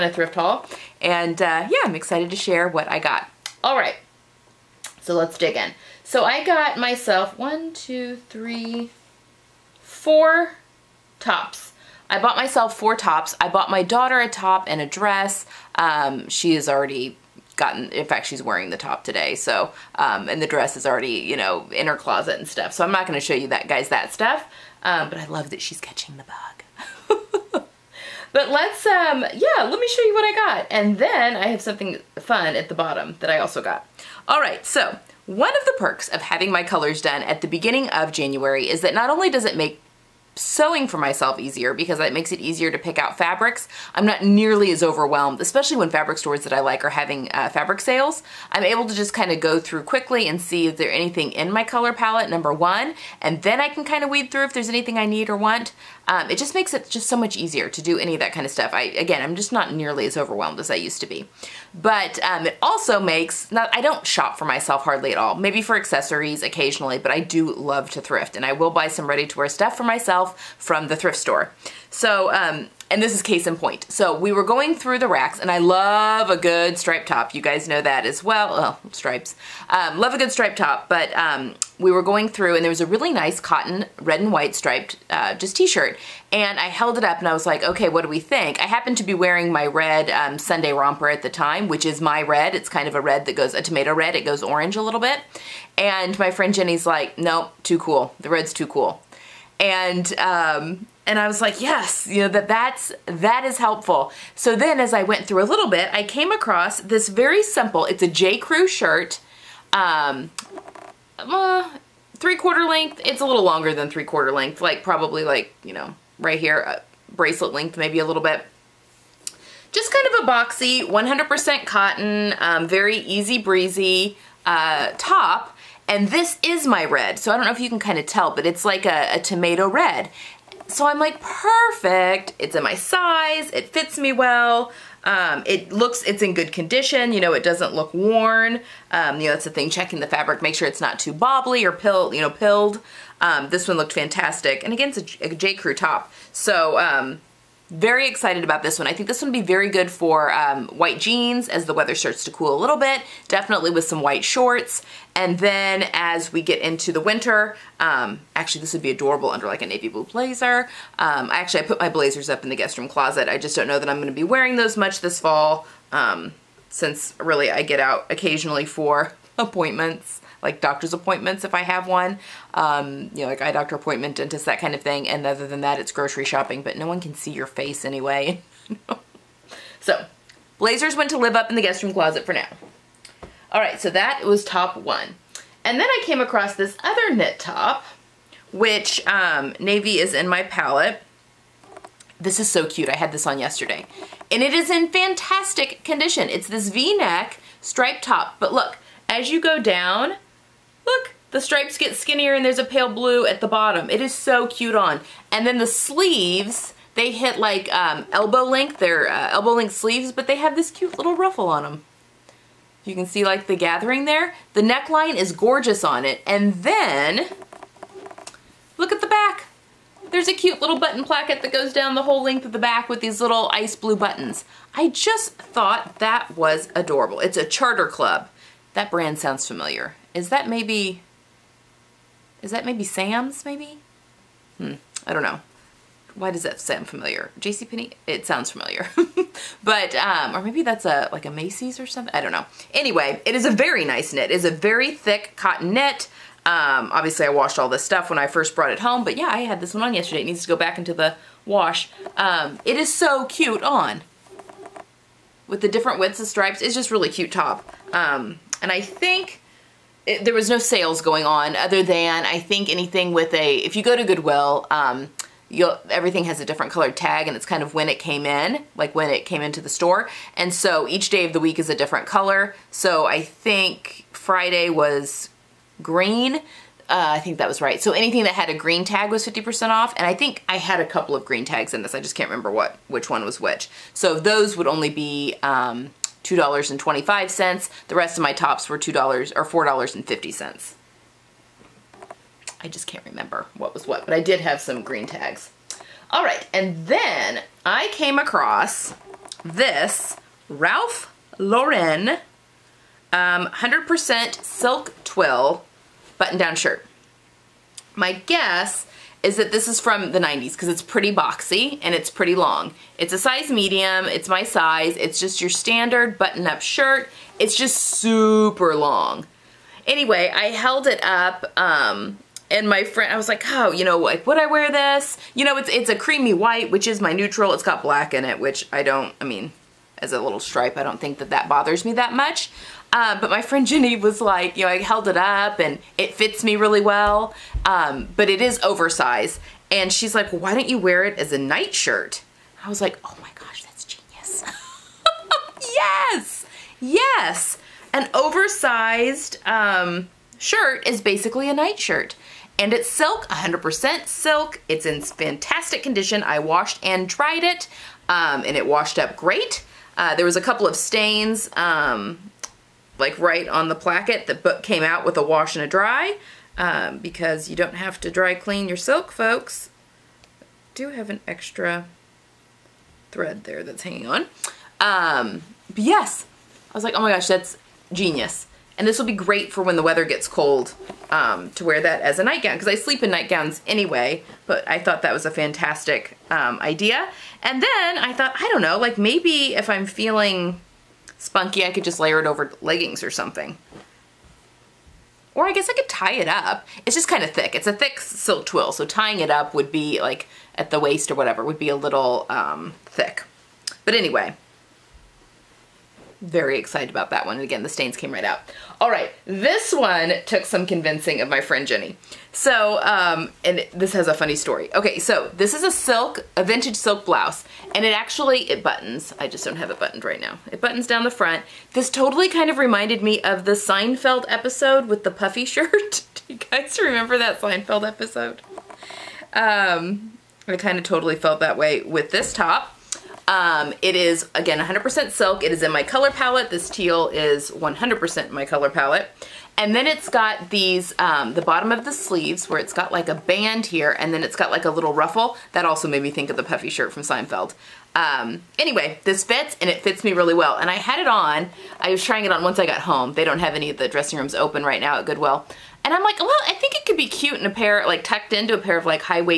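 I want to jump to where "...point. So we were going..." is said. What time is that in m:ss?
1:13.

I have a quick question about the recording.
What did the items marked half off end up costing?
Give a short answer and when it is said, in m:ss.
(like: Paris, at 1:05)
$2.25, at 4:46.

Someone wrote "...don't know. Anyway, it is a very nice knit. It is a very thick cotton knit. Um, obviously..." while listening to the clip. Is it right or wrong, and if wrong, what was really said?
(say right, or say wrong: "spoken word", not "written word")
right.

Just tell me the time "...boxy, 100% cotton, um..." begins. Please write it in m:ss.
2:00.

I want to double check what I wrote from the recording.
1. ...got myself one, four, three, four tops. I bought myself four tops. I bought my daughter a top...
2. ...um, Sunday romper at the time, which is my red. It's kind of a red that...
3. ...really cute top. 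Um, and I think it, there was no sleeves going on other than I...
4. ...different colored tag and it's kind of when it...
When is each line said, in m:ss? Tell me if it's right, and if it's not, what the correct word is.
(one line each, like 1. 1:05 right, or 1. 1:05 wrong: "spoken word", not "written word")
1. 0:06 wrong: "two", not "four"
2. 1:30 right
3. 4:16 wrong: "sales", not "sleeves"
4. 4:26 right.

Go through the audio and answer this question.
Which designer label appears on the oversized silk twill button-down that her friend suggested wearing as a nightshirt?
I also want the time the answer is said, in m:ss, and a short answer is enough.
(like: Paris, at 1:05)
Ralph Lauren, at 5:00.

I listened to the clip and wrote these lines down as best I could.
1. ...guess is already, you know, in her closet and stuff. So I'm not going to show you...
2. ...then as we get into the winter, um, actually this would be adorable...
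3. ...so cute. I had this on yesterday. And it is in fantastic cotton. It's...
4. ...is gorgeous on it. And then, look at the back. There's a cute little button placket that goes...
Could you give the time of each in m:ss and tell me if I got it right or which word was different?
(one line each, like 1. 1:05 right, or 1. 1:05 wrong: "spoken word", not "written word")
1. 0:20 wrong: "dress", not "guess"
2. 2:35 right
3. 3:12 wrong: "condition", not "cotton"
4. 3:35 right.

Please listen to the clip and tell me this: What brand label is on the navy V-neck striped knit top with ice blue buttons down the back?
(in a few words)
Charter Club.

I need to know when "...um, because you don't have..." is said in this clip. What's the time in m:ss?
6:06.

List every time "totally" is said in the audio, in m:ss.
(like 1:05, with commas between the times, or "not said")
7:01, 7:10.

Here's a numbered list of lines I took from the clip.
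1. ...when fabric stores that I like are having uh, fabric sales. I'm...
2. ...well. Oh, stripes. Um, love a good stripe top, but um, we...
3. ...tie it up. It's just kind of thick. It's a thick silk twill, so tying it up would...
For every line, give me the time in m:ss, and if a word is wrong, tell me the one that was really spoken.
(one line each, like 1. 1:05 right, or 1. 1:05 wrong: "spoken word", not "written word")
1. 0:45 right
2. 1:18 right
3. 6:35 right.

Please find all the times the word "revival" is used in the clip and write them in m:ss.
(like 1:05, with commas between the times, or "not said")
not said.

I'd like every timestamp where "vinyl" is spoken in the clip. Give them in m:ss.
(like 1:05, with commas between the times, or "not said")
not said.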